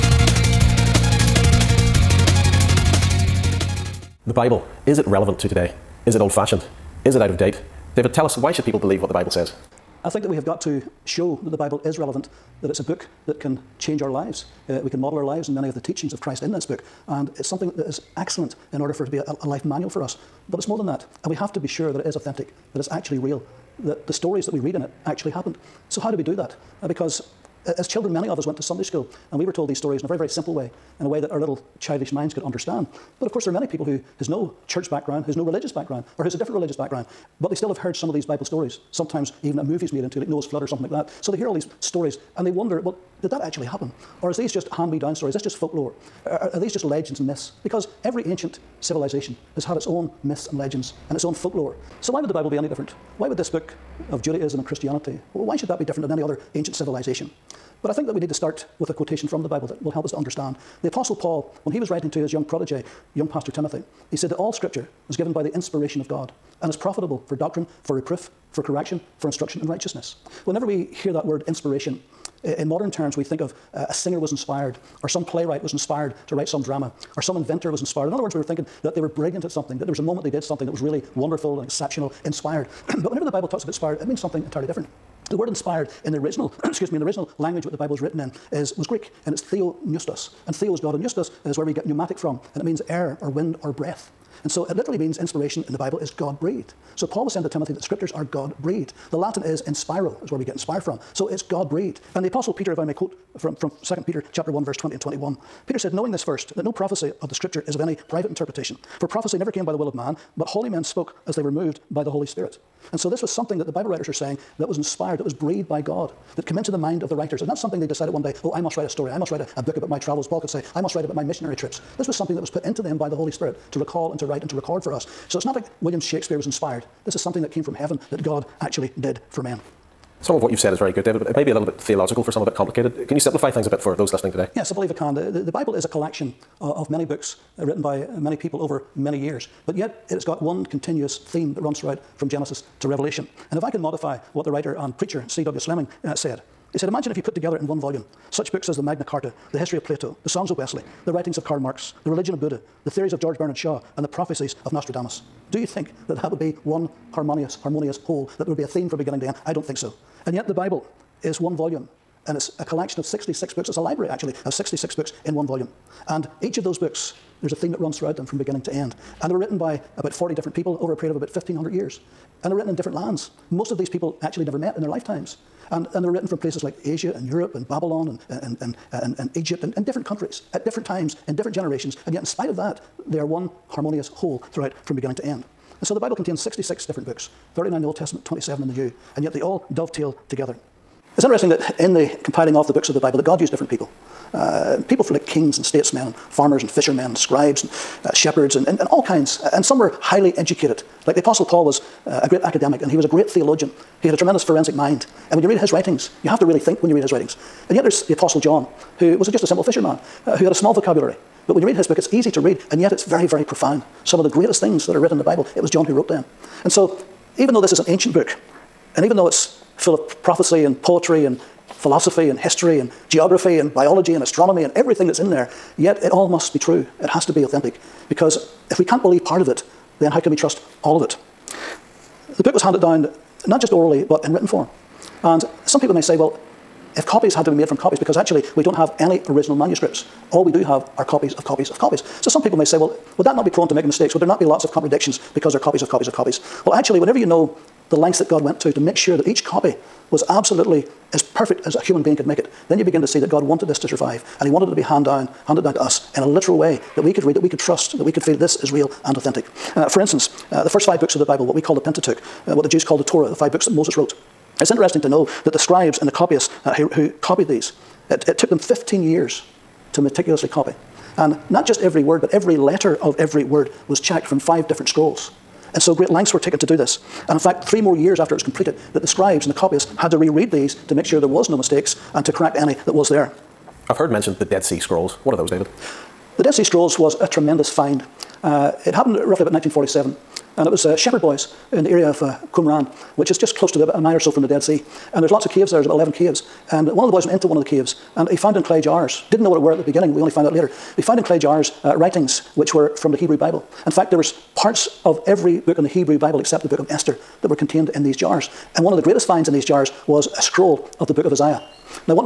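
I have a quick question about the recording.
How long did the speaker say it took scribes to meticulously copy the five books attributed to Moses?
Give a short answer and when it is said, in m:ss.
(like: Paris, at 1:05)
15 years, at 4:28.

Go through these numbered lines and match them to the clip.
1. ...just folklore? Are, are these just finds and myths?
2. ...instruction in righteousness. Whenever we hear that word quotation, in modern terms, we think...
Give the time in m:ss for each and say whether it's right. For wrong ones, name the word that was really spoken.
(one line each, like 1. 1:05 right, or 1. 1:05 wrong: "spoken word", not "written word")
1. 0:45 wrong: "legends", not "finds"
2. 1:09 wrong: "inspiration", not "quotation".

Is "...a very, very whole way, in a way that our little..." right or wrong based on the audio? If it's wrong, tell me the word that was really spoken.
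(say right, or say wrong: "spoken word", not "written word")
wrong: "simple", not "whole".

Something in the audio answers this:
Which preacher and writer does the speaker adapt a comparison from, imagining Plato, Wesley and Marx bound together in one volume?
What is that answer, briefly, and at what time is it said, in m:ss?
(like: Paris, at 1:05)
C.W. Slemming, at 2:25.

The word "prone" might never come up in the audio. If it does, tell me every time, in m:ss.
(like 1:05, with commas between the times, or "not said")
4:03.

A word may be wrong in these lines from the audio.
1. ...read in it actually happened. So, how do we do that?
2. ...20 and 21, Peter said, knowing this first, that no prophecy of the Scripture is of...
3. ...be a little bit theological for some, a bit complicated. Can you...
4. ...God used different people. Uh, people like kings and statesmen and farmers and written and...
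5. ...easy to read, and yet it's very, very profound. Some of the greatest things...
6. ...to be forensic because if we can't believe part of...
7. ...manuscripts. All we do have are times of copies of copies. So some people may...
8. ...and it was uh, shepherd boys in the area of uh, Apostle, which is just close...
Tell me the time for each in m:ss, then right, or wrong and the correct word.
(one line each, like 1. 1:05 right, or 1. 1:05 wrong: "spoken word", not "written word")
1. 0:24 right
2. 1:44 right
3. 2:11 right
4. 3:13 wrong: "fishermen", not "written"
5. 3:32 right
6. 3:47 wrong: "authentic", not "forensic"
7. 3:59 wrong: "copies", not "times"
8. 4:50 wrong: "Qumran", not "Apostle".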